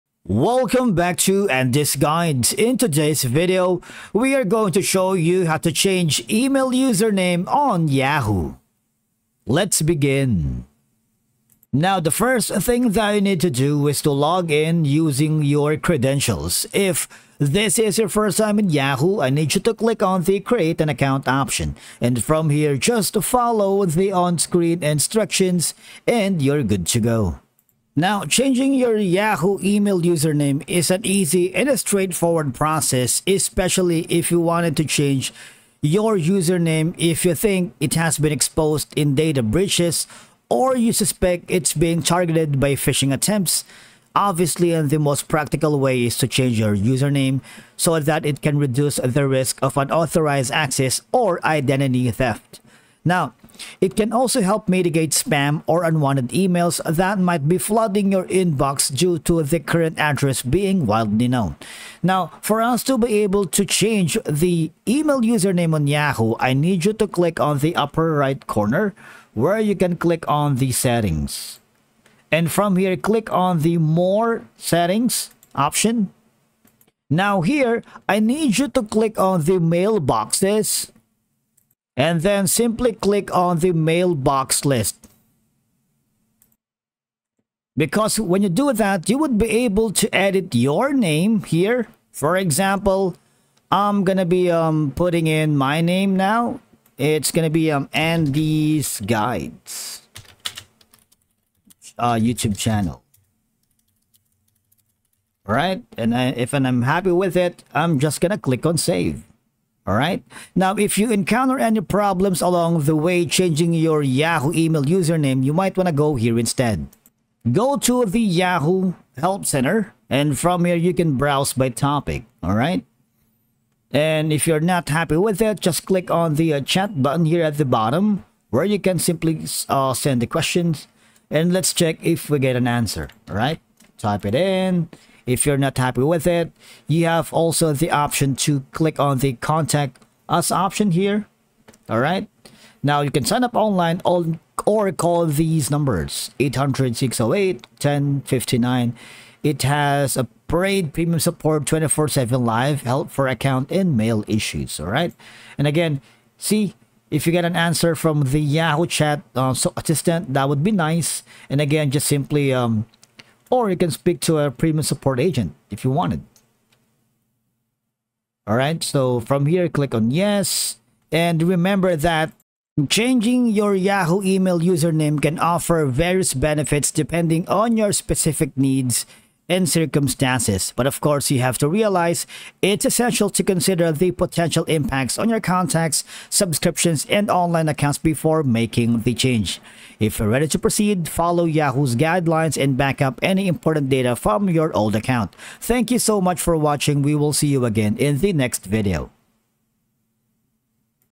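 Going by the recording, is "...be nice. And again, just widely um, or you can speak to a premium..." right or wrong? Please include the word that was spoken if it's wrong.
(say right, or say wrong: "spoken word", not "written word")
wrong: "simply", not "widely".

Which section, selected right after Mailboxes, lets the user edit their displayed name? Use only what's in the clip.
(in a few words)
Mailbox list.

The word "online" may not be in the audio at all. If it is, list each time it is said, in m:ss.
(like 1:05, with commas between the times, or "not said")
2:23, 3:07.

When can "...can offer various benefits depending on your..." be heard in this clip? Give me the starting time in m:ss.
2:55.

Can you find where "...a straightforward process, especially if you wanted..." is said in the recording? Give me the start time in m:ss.
0:31.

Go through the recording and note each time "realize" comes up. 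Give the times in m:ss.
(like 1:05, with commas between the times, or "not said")
3:01.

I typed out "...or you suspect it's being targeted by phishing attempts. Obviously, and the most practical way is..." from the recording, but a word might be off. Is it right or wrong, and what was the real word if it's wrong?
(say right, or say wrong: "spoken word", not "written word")
right.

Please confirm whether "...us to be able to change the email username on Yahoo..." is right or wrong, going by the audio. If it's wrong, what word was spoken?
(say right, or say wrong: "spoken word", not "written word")
right.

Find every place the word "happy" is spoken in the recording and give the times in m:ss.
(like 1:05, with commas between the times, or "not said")
1:46, 2:04, 2:15.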